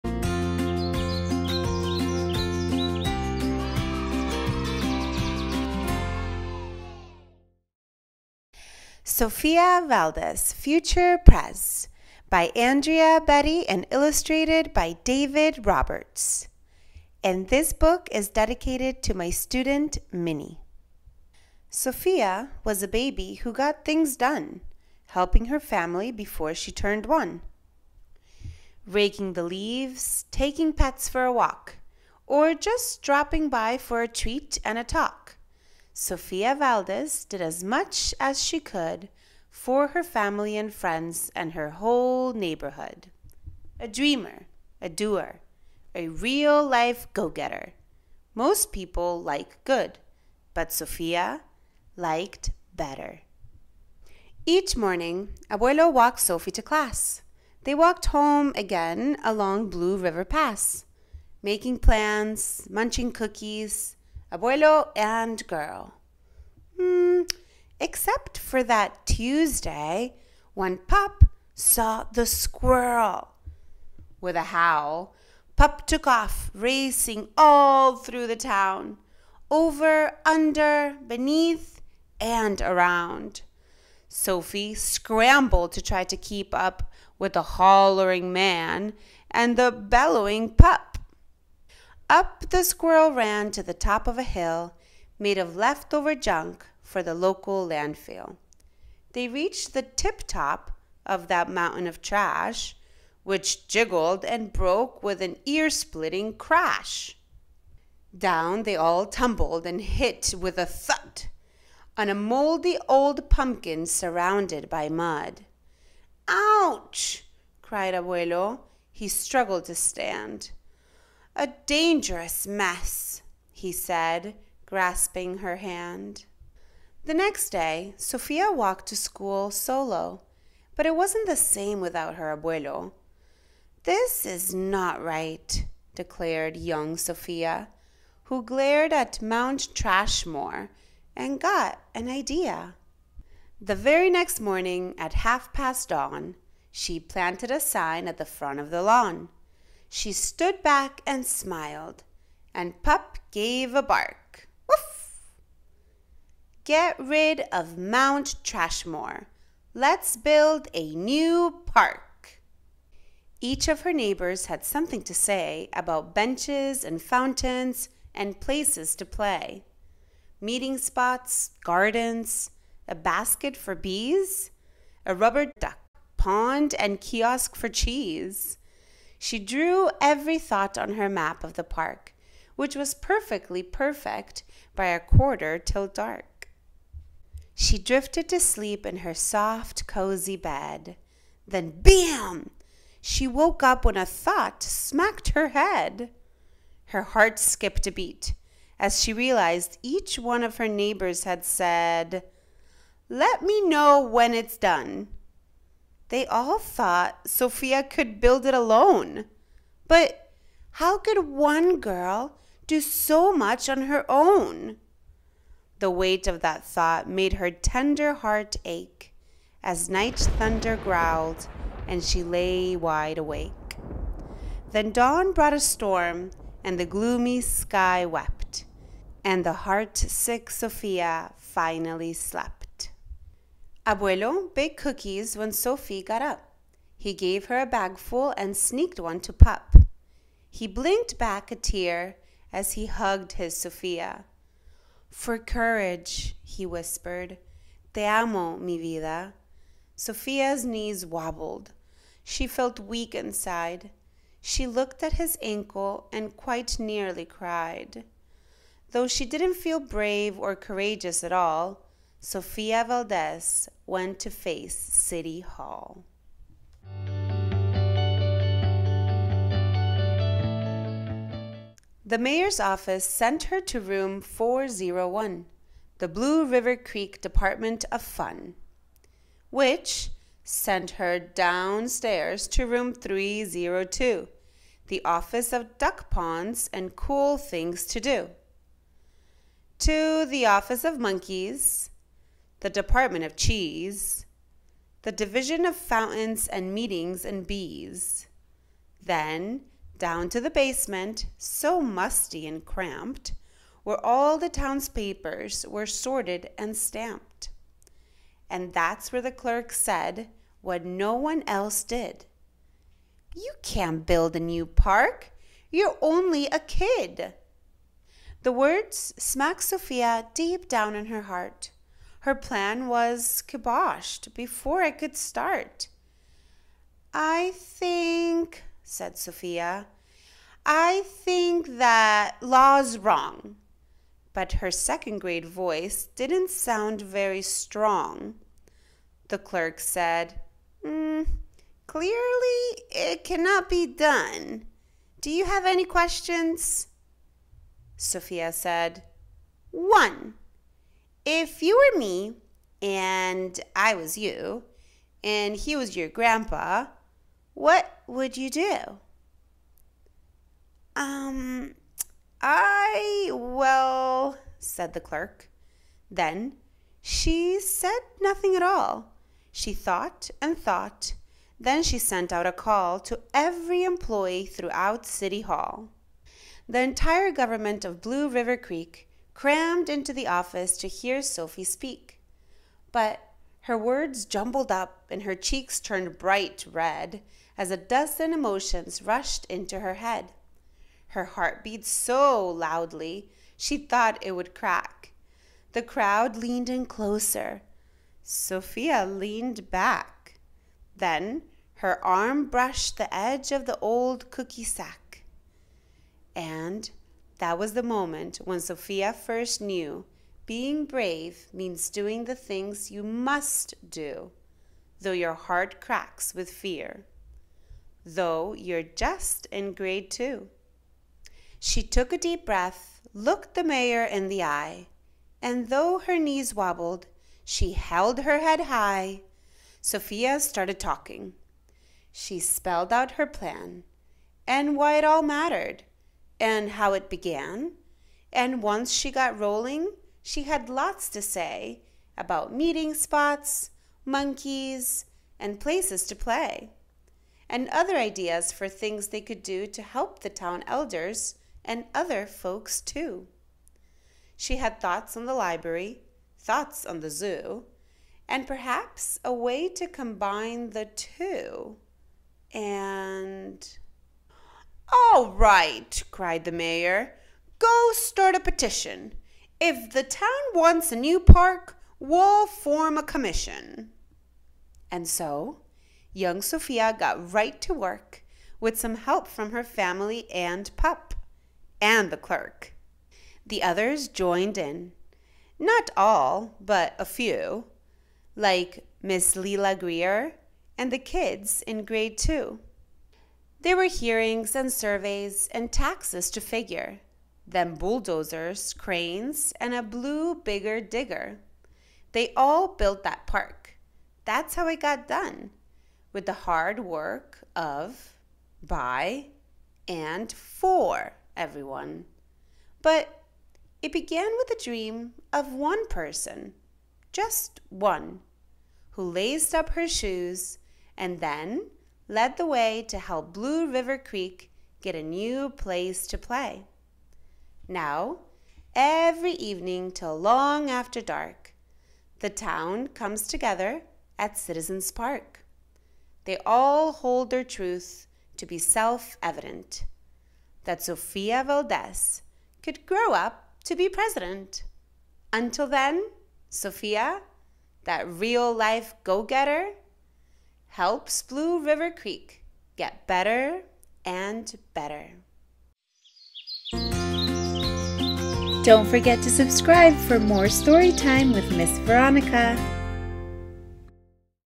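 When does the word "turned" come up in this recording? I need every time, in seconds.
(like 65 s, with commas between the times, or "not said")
26 s, 385 s.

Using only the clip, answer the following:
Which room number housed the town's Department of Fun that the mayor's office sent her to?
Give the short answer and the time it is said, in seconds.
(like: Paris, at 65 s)
401, at 274 s.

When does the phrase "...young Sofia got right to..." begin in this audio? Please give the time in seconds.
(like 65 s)
476 s.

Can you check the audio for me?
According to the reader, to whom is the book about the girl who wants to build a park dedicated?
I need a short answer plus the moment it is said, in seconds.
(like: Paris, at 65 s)
Minnie, at 20 s.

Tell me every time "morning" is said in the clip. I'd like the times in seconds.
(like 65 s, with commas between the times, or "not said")
54 s, 144 s.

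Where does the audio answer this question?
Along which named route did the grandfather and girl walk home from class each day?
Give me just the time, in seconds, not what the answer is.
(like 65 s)
59 s.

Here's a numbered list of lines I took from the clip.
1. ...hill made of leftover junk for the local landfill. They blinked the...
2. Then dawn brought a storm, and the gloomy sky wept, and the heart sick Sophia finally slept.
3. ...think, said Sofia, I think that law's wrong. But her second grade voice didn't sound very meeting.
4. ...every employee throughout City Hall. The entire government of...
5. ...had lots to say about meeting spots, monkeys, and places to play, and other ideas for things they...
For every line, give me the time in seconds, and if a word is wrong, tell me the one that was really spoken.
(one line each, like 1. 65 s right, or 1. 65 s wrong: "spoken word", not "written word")
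1. 94 s wrong: "reached", not "blinked"
2. 224 s right
3. 327 s wrong: "strong", not "meeting"
4. 373 s right
5. 440 s right.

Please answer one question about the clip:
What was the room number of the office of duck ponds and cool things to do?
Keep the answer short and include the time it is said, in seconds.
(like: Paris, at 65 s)
302, at 282 s.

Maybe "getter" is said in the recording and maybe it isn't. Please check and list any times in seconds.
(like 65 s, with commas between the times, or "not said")
47 s, 549 s.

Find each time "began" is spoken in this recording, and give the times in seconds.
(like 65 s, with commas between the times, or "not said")
437 s, 513 s.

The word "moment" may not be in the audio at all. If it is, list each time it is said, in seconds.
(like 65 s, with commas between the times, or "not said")
407 s.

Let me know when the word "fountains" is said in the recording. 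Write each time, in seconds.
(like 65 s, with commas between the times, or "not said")
167 s, 295 s.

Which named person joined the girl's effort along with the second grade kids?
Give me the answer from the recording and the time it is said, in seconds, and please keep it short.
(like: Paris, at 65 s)
Leela Greer, at 489 s.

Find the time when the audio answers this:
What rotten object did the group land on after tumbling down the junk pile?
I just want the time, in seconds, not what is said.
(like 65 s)
113 s.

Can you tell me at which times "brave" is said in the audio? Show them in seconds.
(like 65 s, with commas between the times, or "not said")
259 s, 410 s.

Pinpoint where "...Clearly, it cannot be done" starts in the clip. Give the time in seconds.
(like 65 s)
341 s.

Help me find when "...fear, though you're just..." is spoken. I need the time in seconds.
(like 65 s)
416 s.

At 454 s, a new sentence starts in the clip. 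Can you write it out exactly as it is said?
She had thoughts on the library, thoughts on the zoo, and perhaps a way to combine the two.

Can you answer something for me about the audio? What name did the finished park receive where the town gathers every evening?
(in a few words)
Citizens Park.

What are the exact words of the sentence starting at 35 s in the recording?
Sofia Valdez did as much as she could for her family and friends and her whole neighborhood.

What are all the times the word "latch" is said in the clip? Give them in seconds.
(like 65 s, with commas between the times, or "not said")
not said.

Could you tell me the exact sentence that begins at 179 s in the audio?
She drew every thought on her map of the park, which was perfectly perfect by a quarter till dark.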